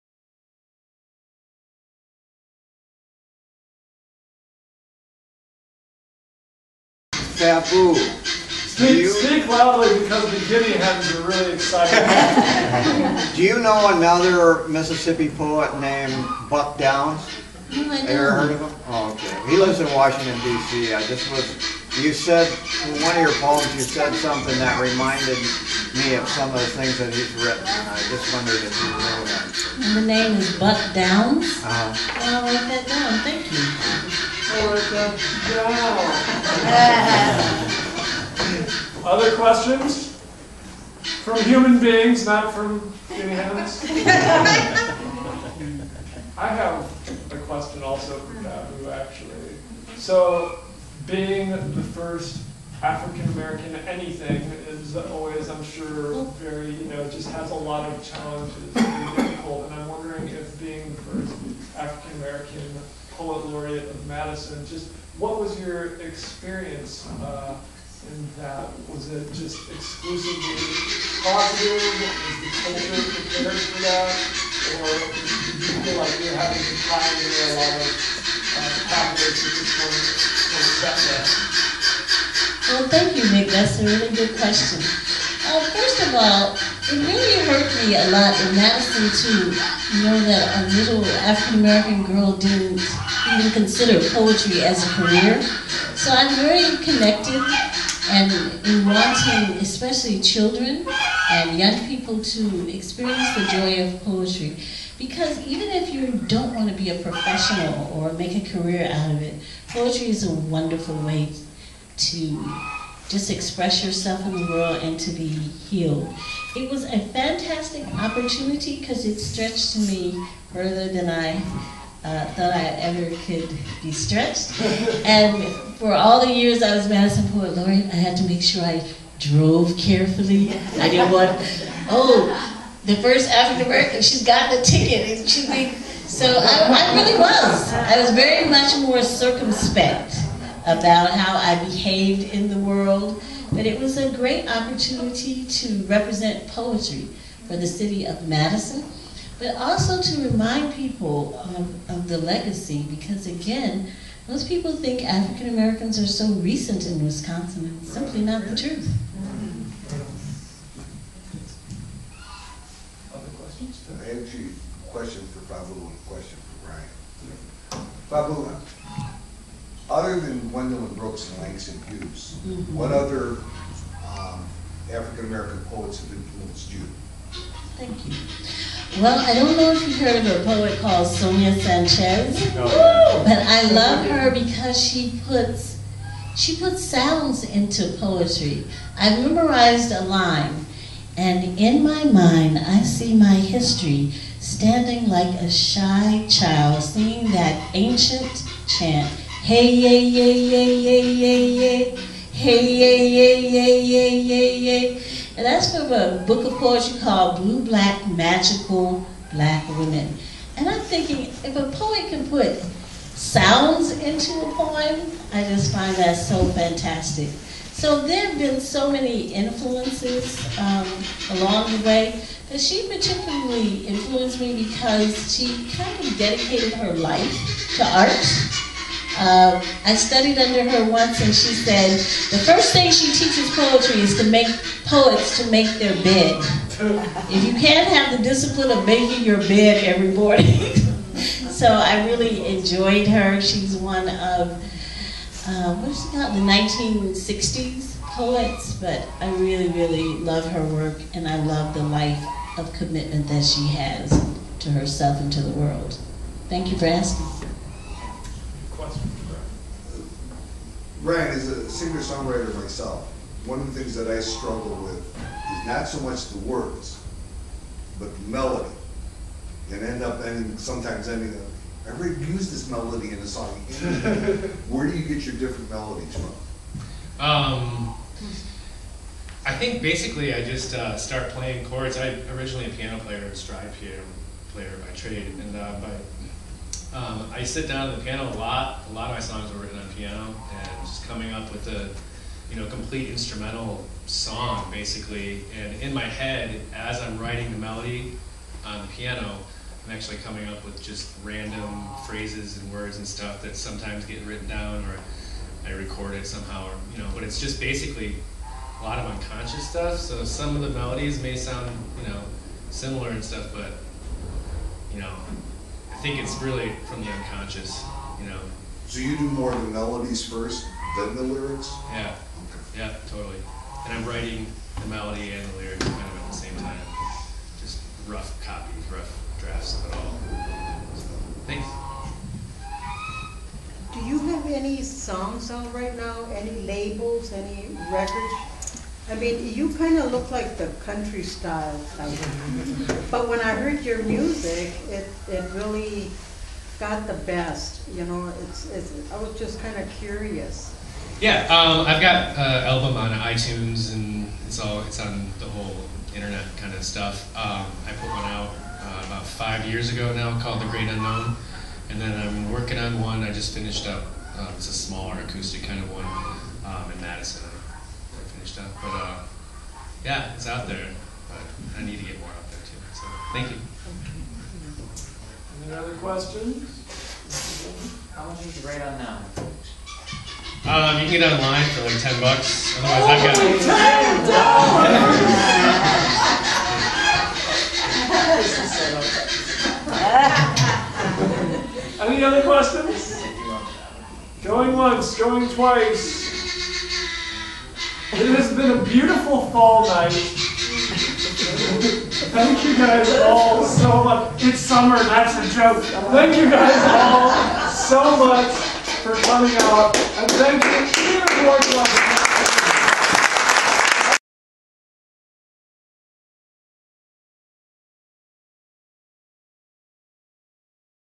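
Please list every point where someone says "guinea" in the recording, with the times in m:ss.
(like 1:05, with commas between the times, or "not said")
0:10, 0:43.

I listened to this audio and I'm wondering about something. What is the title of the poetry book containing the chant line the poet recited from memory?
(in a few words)
Blue Black Magical Black Women.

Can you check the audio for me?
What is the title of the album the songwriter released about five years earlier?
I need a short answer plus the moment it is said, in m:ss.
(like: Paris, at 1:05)
The Great Unknown, at 6:00.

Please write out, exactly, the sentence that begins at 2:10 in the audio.
I didn't want, oh, the first African American, she's got the ticket.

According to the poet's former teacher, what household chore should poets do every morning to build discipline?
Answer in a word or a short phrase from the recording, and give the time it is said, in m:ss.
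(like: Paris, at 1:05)
make their bed, at 3:55.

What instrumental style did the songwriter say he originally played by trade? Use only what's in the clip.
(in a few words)
stride piano.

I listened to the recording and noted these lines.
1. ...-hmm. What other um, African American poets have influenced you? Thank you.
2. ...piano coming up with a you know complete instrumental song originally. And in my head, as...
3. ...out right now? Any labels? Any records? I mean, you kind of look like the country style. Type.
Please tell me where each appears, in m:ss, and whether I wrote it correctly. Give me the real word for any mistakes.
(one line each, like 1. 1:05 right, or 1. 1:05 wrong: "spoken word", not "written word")
1. 2:52 right
2. 4:49 wrong: "basically", not "originally"
3. 5:35 right.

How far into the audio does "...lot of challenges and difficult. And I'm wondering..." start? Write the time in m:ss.
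0:57.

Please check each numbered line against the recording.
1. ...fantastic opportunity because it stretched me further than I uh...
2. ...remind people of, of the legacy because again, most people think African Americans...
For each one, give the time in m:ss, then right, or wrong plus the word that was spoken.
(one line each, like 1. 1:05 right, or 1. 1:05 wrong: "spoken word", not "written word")
1. 1:56 right
2. 2:30 right.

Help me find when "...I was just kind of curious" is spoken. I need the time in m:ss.
5:49.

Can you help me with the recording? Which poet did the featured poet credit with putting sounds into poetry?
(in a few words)
Sonia Sanchez.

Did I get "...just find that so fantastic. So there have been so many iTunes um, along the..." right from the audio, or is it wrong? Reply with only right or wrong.
wrong.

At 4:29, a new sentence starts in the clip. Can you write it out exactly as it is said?
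And end up ending, sometimes ending up, I already used this melody in a song.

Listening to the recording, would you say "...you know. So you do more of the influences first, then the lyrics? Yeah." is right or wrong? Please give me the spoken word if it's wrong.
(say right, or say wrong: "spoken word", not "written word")
wrong: "melodies", not "influences".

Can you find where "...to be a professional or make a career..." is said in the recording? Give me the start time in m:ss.
1:46.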